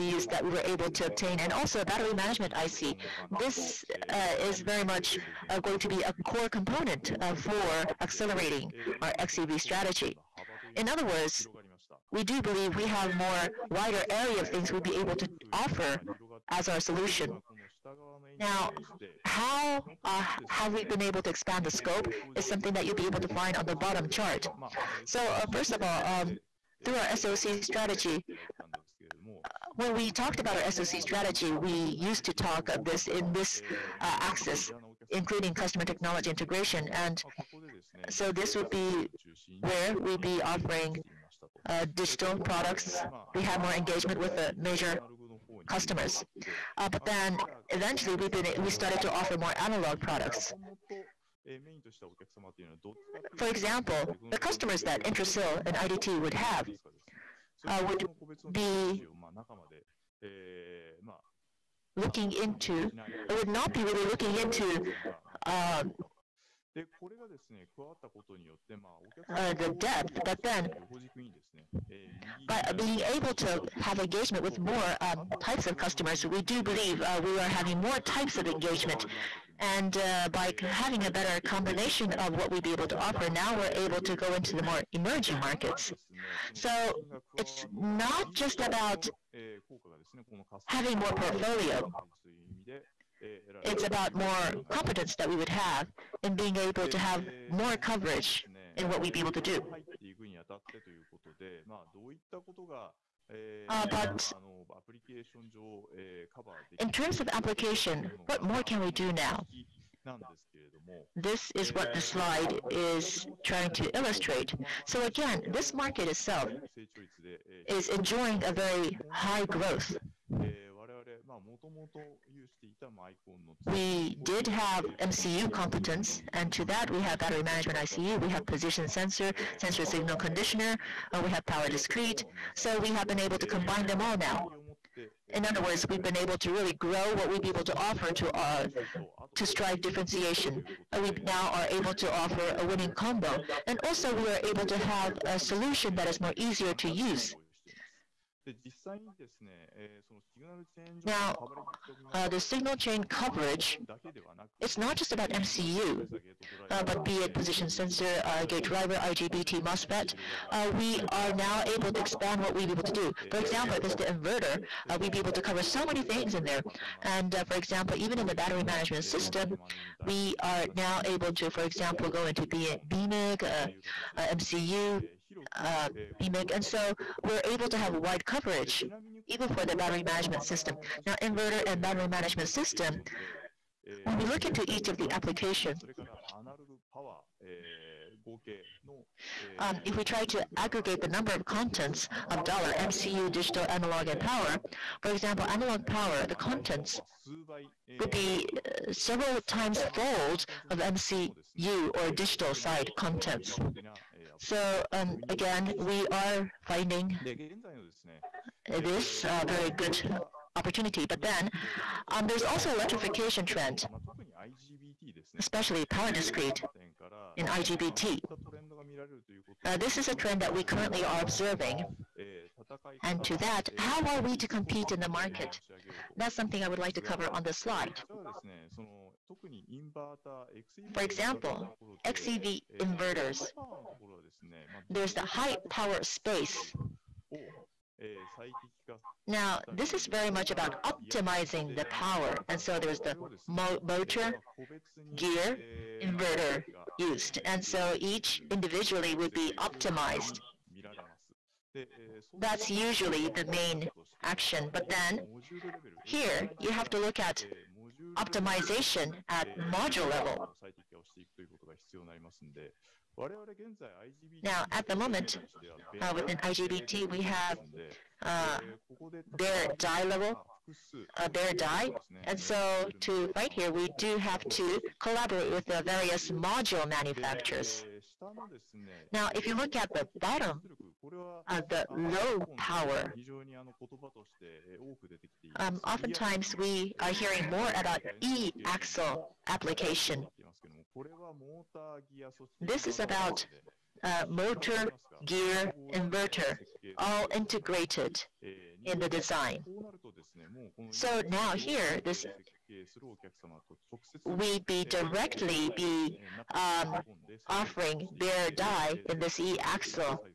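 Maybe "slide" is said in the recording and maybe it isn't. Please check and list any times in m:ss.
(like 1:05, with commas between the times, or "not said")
1:52, 3:47.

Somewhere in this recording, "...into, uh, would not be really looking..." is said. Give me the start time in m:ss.
1:02.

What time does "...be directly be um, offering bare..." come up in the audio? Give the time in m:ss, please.
5:04.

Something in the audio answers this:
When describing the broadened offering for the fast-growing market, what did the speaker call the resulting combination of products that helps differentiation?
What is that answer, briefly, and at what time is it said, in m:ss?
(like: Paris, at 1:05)
winning combo, at 2:22.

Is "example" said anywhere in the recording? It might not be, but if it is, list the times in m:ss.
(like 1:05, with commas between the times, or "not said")
0:53, 2:43, 2:47, 2:51, 3:15, 3:51.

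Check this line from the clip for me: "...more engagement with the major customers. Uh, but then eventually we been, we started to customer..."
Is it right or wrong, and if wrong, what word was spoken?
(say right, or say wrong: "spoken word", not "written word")
wrong: "offer", not "customer".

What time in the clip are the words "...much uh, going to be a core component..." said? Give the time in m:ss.
0:04.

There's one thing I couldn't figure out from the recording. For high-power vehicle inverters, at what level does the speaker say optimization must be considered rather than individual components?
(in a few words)
module level.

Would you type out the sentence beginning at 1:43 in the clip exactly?
Uh, but in terms of application, what more can we do now?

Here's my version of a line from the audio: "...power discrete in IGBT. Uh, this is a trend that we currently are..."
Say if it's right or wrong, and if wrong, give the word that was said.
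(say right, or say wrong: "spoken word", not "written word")
right.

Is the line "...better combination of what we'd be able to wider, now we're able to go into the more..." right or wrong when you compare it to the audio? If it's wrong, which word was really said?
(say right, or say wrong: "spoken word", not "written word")
wrong: "offer", not "wider".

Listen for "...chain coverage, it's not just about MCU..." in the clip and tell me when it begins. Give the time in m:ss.
2:32.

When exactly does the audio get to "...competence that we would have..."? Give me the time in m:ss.
1:34.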